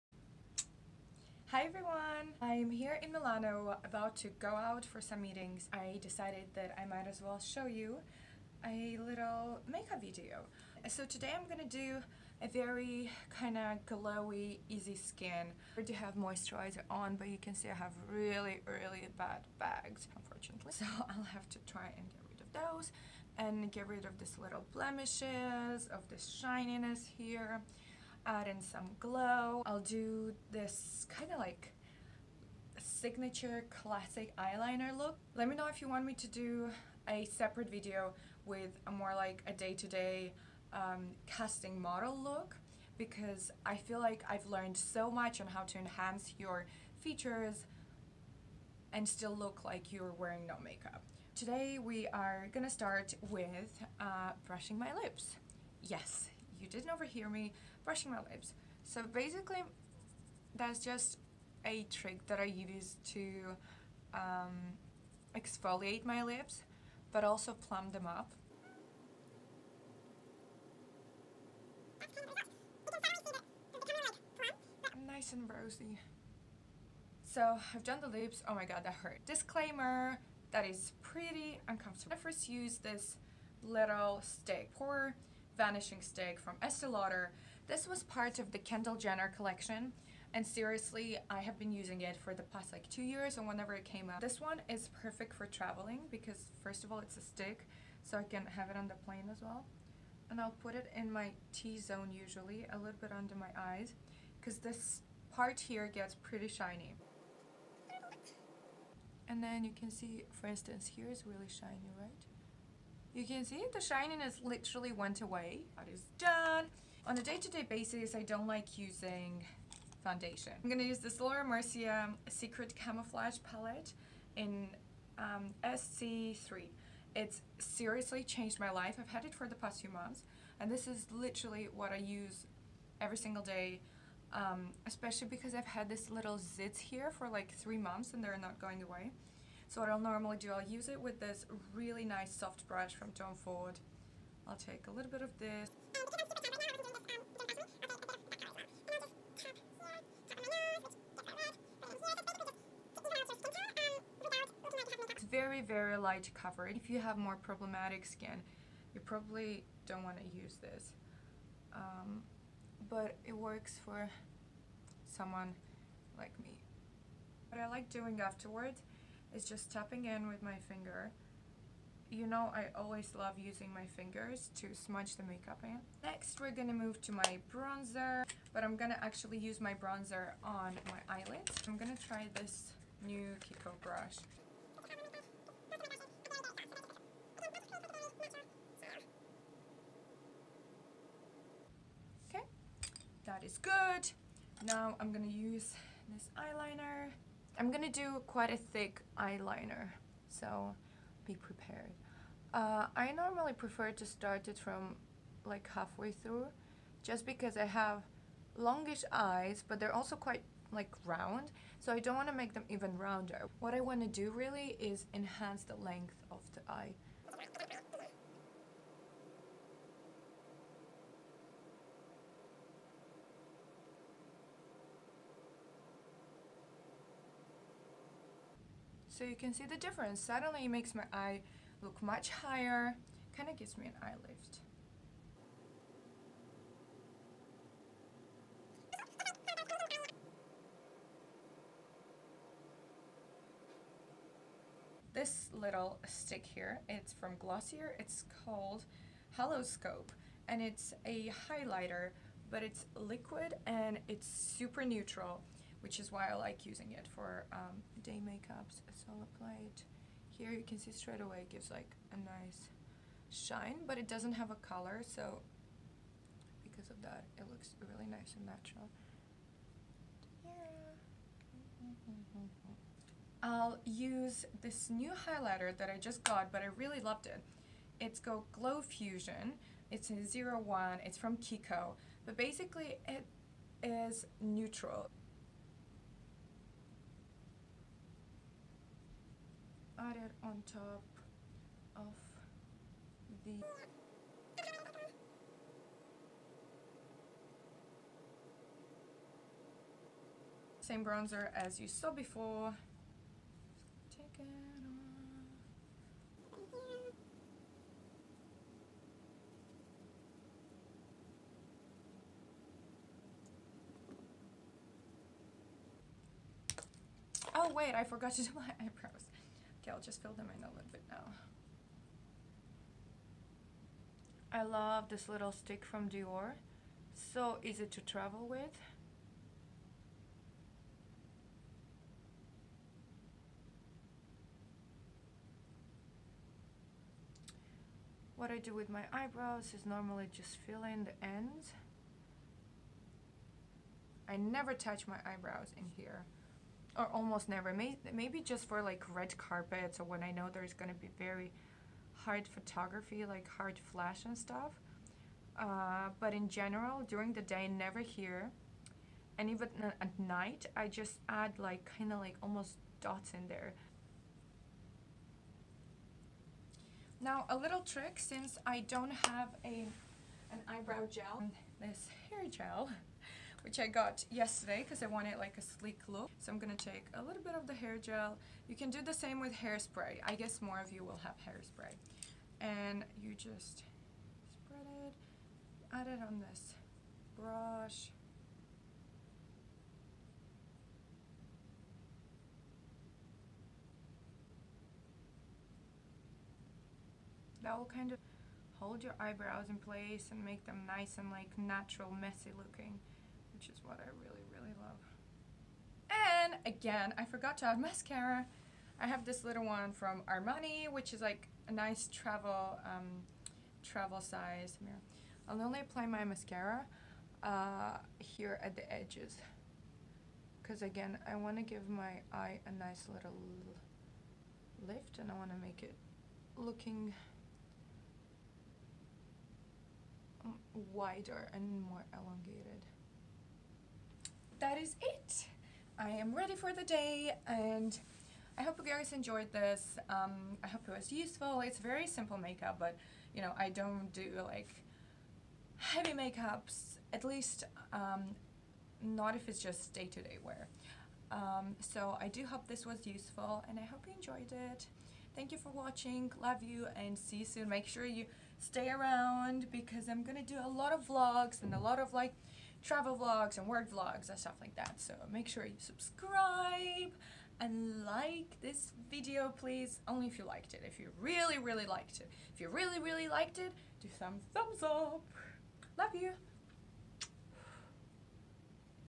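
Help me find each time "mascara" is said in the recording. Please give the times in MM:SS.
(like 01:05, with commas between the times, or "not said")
06:47, 06:56.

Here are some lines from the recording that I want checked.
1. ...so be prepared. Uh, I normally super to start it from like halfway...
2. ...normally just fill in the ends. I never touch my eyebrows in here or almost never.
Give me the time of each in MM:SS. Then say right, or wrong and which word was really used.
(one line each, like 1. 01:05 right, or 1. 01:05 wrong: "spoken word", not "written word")
1. 03:20 wrong: "prefer", not "super"
2. 05:39 right.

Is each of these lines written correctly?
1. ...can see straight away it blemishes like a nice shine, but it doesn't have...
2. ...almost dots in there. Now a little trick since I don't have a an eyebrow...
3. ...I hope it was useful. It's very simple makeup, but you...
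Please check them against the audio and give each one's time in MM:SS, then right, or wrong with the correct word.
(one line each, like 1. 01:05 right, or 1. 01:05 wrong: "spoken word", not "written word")
1. 04:20 wrong: "gives", not "blemishes"
2. 06:02 right
3. 07:20 right.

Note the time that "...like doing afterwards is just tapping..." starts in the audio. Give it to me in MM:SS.
02:47.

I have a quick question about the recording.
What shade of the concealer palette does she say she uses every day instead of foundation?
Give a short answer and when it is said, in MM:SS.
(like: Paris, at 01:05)
SC3, at 02:05.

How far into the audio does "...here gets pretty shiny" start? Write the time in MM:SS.
01:45.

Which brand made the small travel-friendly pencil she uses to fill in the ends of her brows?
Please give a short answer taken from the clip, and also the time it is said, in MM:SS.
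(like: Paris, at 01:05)
Dior, at 05:26.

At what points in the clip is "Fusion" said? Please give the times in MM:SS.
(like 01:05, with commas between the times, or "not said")
04:38.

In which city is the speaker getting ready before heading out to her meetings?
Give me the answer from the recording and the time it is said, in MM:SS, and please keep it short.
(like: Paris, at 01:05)
Milano, at 00:03.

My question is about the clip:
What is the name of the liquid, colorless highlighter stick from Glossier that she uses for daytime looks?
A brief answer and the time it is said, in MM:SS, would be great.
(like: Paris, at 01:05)
Hollow, at 04:09.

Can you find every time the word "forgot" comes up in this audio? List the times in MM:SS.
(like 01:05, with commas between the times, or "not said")
05:18, 06:47.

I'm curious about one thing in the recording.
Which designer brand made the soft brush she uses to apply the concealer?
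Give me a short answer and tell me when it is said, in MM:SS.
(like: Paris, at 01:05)
Tom Ford, at 02:23.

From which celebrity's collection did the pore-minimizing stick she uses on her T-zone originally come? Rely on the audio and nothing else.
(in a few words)
Kendall Jenner.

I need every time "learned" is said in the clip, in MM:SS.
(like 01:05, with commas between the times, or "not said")
00:44.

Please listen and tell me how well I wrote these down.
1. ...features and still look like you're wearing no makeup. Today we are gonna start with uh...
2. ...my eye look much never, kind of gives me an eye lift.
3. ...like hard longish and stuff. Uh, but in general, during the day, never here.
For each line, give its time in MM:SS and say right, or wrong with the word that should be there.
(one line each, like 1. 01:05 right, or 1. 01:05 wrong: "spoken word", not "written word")
1. 00:46 right
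2. 03:50 wrong: "higher", not "never"
3. 05:53 wrong: "flash", not "longish".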